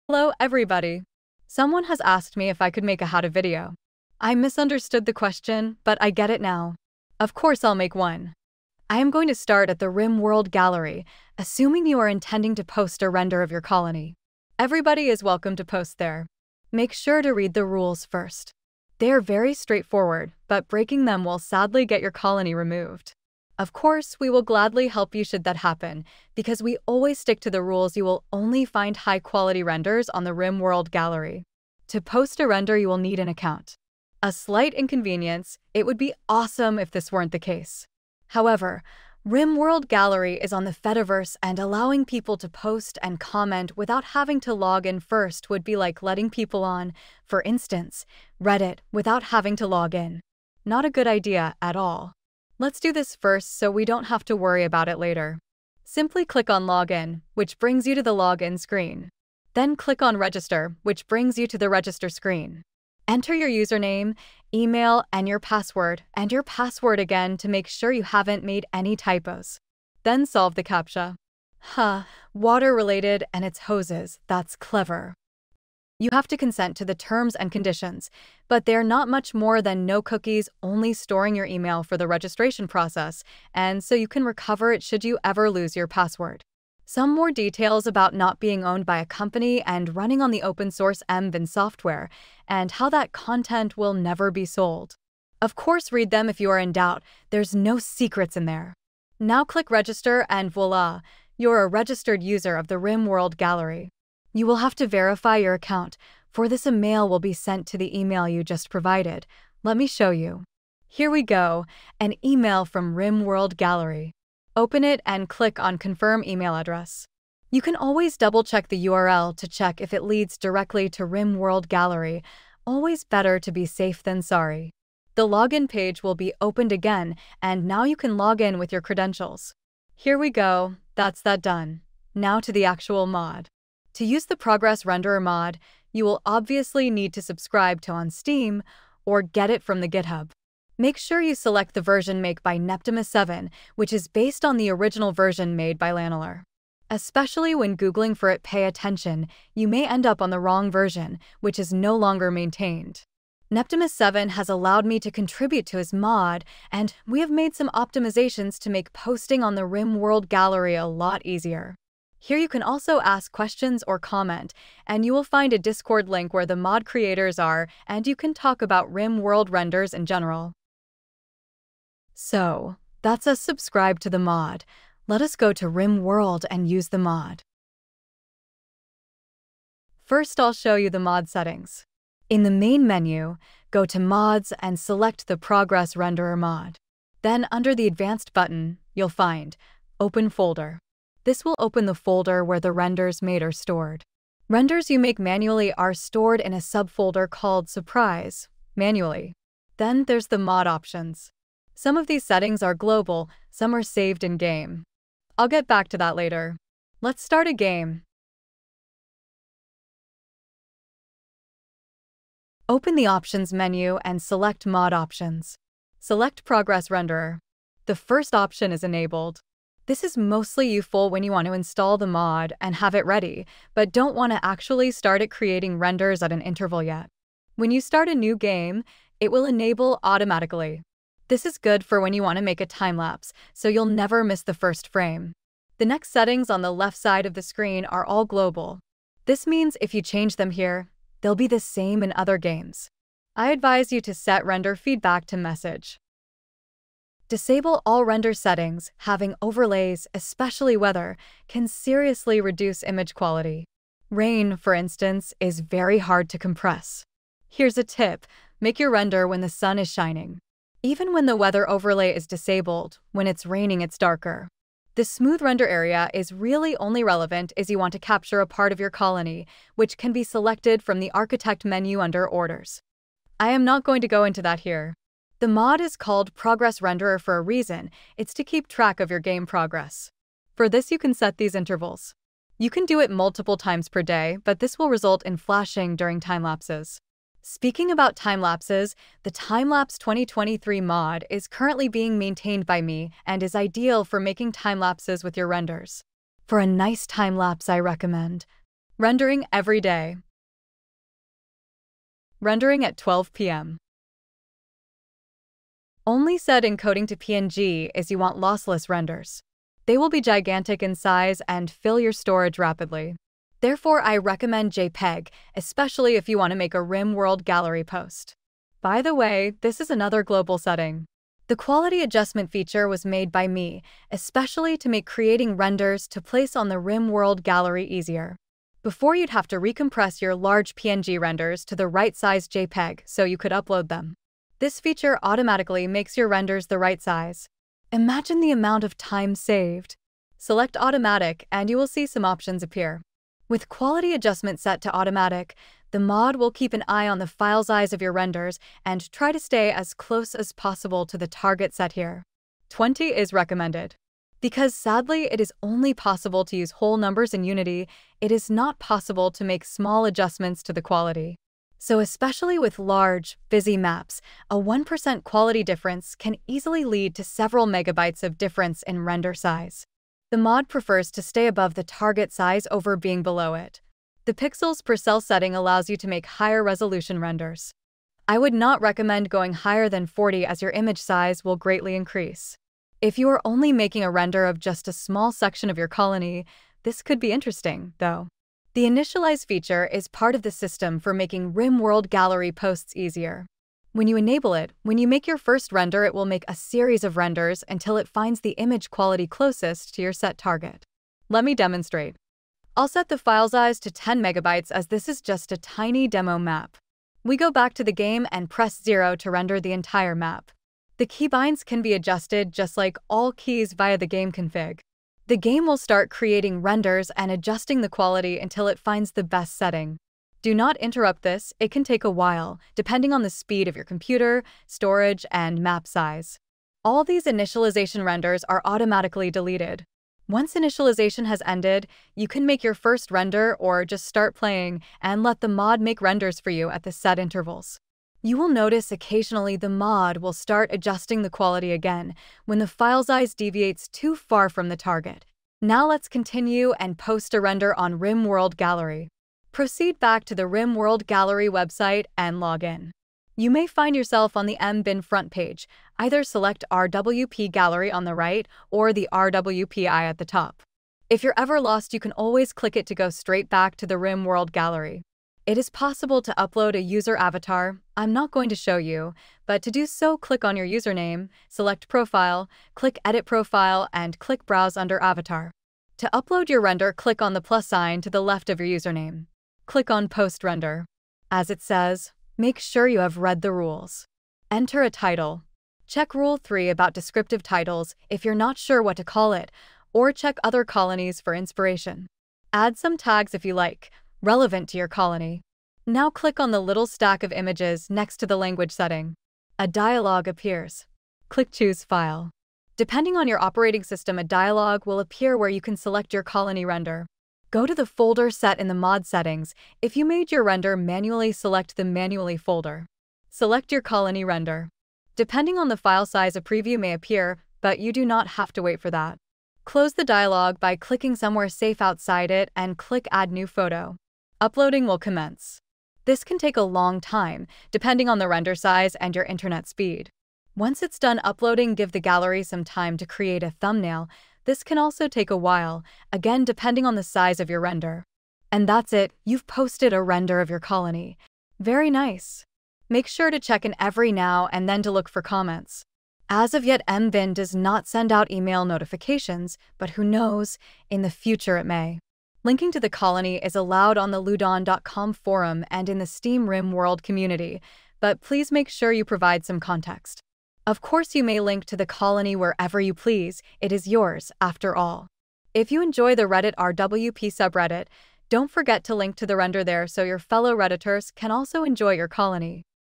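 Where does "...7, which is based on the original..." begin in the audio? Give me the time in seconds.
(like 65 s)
143 s.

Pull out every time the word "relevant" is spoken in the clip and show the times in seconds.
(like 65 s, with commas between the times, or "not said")
267 s, 494 s.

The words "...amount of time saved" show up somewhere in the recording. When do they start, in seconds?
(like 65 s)
338 s.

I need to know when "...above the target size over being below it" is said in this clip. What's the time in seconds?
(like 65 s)
371 s.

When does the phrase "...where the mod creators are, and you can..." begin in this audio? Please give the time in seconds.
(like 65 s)
166 s.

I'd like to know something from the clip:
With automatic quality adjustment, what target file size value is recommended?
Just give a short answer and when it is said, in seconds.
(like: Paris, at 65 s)
20, at 352 s.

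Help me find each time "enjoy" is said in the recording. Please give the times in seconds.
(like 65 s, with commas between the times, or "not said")
565 s, 571 s.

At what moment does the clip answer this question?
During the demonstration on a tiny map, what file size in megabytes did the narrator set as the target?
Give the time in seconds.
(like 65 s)
403 s.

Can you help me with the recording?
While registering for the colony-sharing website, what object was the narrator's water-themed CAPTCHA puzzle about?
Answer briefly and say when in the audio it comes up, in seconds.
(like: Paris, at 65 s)
hoses, at 73 s.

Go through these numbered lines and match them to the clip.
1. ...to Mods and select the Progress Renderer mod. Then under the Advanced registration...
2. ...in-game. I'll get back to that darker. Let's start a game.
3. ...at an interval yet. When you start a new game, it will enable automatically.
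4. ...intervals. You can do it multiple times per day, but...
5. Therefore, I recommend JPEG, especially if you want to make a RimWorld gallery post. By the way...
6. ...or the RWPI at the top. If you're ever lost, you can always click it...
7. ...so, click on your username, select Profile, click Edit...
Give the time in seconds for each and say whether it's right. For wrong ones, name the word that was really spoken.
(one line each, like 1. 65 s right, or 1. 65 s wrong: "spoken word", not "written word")
1. 183 s wrong: "button", not "registration"
2. 204 s wrong: "later", not "darker"
3. 226 s right
4. 281 s right
5. 313 s right
6. 458 s right
7. 469 s right.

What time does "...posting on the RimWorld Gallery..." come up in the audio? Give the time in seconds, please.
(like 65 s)
158 s.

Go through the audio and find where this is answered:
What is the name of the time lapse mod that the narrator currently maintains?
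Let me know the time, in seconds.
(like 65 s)
289 s.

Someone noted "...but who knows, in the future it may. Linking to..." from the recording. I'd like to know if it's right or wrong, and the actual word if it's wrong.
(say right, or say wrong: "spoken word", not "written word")
right.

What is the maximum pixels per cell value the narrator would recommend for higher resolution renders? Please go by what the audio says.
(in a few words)
40.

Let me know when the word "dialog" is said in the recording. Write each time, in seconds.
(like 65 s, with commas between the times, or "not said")
499 s, 504 s, 520 s.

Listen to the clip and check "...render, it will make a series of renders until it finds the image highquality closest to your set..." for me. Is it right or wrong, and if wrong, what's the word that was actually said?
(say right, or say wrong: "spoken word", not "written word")
wrong: "quality", not "highquality".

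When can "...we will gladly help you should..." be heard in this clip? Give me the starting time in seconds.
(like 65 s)
24 s.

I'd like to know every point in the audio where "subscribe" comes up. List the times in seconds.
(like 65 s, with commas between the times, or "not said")
137 s, 173 s.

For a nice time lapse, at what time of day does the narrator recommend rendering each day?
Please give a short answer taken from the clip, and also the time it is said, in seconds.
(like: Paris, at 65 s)
12 p.m., at 302 s.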